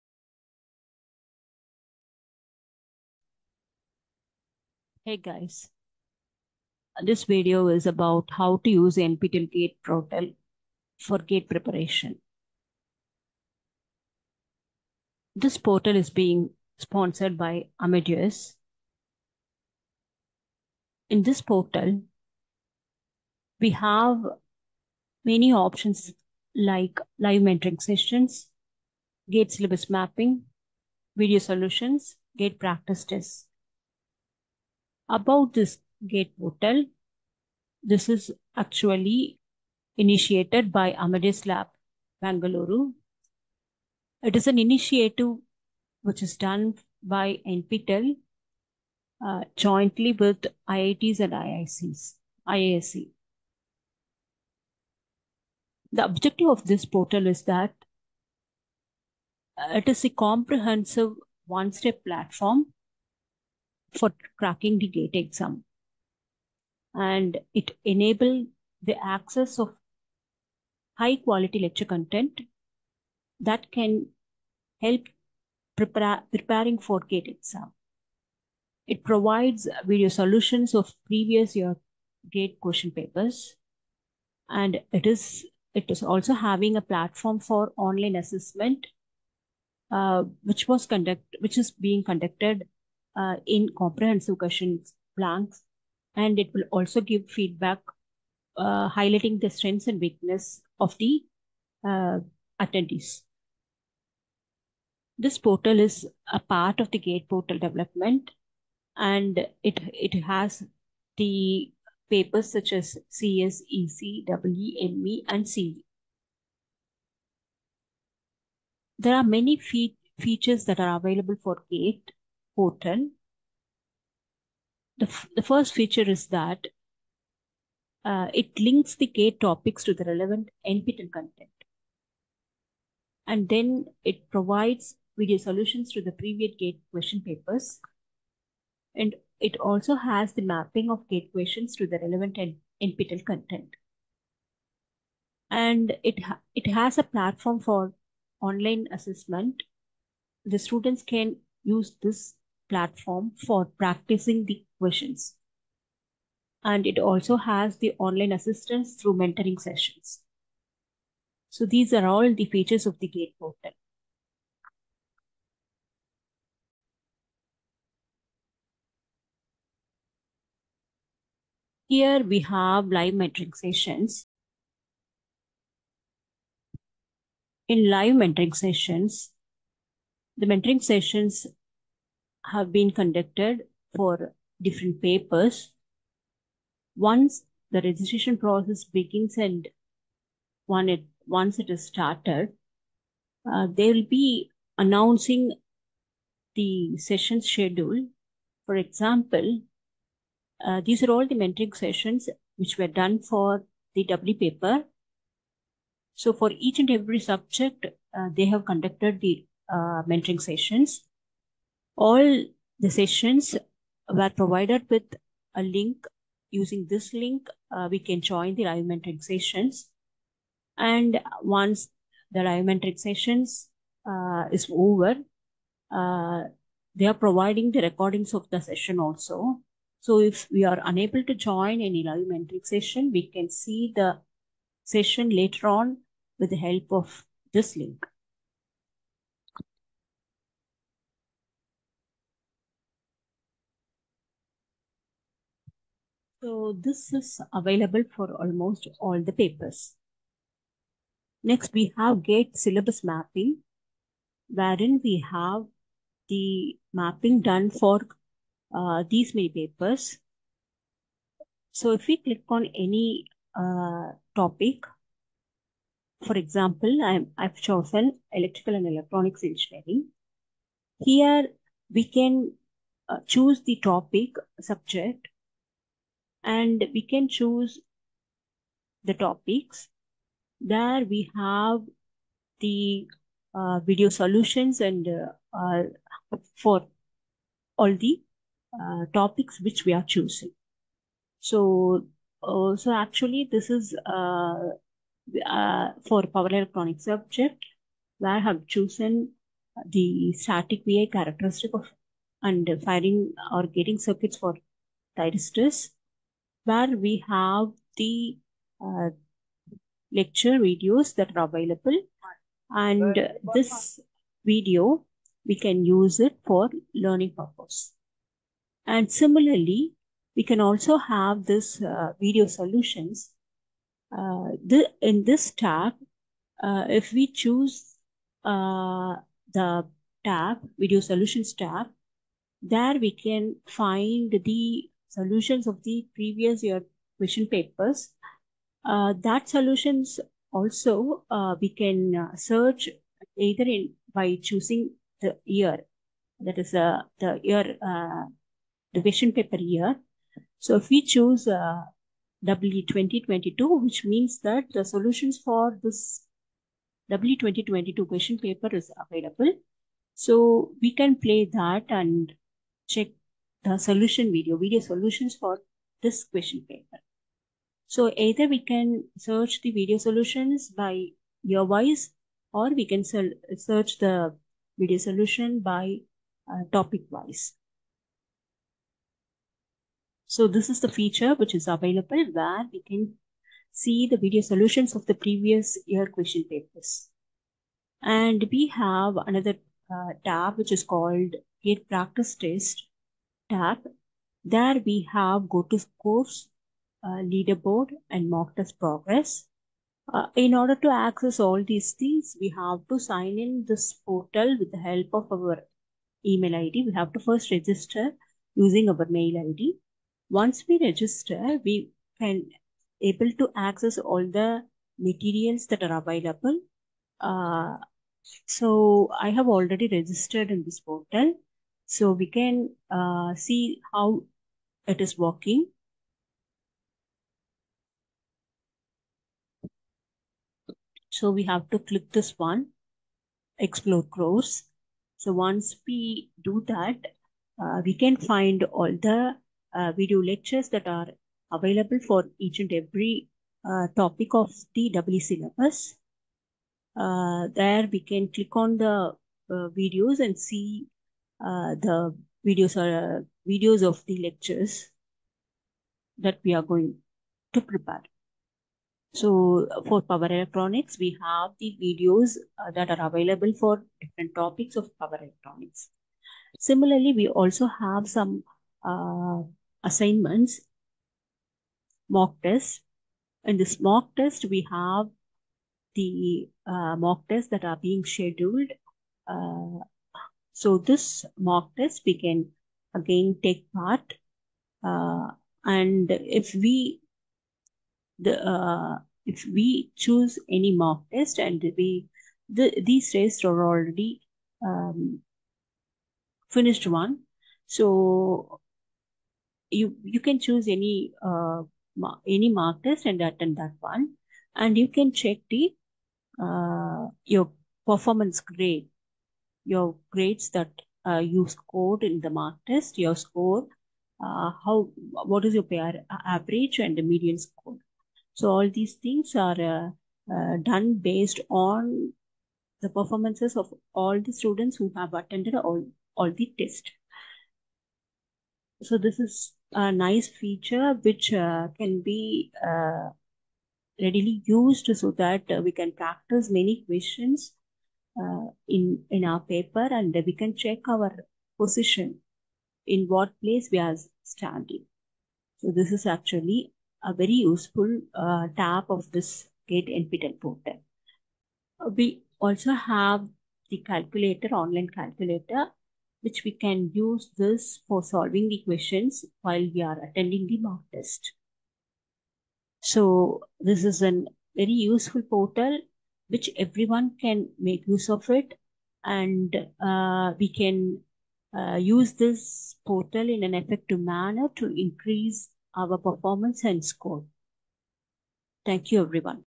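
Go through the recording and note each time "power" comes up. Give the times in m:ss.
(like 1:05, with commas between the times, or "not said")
4:56, 7:40, 7:44.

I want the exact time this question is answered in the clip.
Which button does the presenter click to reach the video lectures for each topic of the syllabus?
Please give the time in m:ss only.
7:13.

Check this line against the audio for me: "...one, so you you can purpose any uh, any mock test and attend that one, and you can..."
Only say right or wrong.
wrong.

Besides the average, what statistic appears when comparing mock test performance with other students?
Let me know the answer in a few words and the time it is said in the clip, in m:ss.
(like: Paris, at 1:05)
Median score, at 8:37.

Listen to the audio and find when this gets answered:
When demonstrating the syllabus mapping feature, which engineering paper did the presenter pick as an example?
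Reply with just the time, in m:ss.
4:28.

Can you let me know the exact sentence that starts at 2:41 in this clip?
So these are all the features of the GATE portal.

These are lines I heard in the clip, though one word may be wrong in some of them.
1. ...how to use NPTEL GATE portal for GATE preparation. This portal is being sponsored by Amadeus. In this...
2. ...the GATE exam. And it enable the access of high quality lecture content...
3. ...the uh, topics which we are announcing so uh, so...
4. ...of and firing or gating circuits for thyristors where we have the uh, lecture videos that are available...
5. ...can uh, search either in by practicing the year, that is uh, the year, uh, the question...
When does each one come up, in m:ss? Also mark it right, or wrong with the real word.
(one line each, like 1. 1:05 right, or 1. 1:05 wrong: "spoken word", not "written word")
1. 0:08 right
2. 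1:04 right
3. 4:47 wrong: "choosing", not "announcing"
4. 5:01 right
5. 5:41 wrong: "choosing", not "practicing".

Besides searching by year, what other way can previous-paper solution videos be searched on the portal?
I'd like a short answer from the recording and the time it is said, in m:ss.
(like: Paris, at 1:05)
Topic wise, at 6:16.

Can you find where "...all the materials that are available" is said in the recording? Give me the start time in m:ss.
6:53.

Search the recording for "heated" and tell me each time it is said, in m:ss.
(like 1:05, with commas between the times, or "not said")
not said.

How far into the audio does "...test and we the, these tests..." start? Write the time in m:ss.
8:11.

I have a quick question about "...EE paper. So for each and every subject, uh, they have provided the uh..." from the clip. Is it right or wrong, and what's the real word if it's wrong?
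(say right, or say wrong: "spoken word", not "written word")
wrong: "conducted", not "provided".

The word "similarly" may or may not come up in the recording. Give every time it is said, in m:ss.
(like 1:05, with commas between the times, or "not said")
5:19, 7:46.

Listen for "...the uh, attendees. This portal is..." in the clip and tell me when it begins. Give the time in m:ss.
1:40.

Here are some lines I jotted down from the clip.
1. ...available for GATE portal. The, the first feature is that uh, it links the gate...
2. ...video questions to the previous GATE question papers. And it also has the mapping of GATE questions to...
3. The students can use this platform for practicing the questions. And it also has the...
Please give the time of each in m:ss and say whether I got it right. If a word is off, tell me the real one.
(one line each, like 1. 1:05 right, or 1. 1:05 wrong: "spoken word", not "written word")
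1. 2:00 right
2. 2:15 wrong: "solutions", not "questions"
3. 2:30 right.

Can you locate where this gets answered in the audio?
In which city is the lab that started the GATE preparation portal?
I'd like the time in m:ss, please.
0:42.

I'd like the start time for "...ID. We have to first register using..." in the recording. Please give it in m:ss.
6:46.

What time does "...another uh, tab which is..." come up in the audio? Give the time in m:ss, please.
6:29.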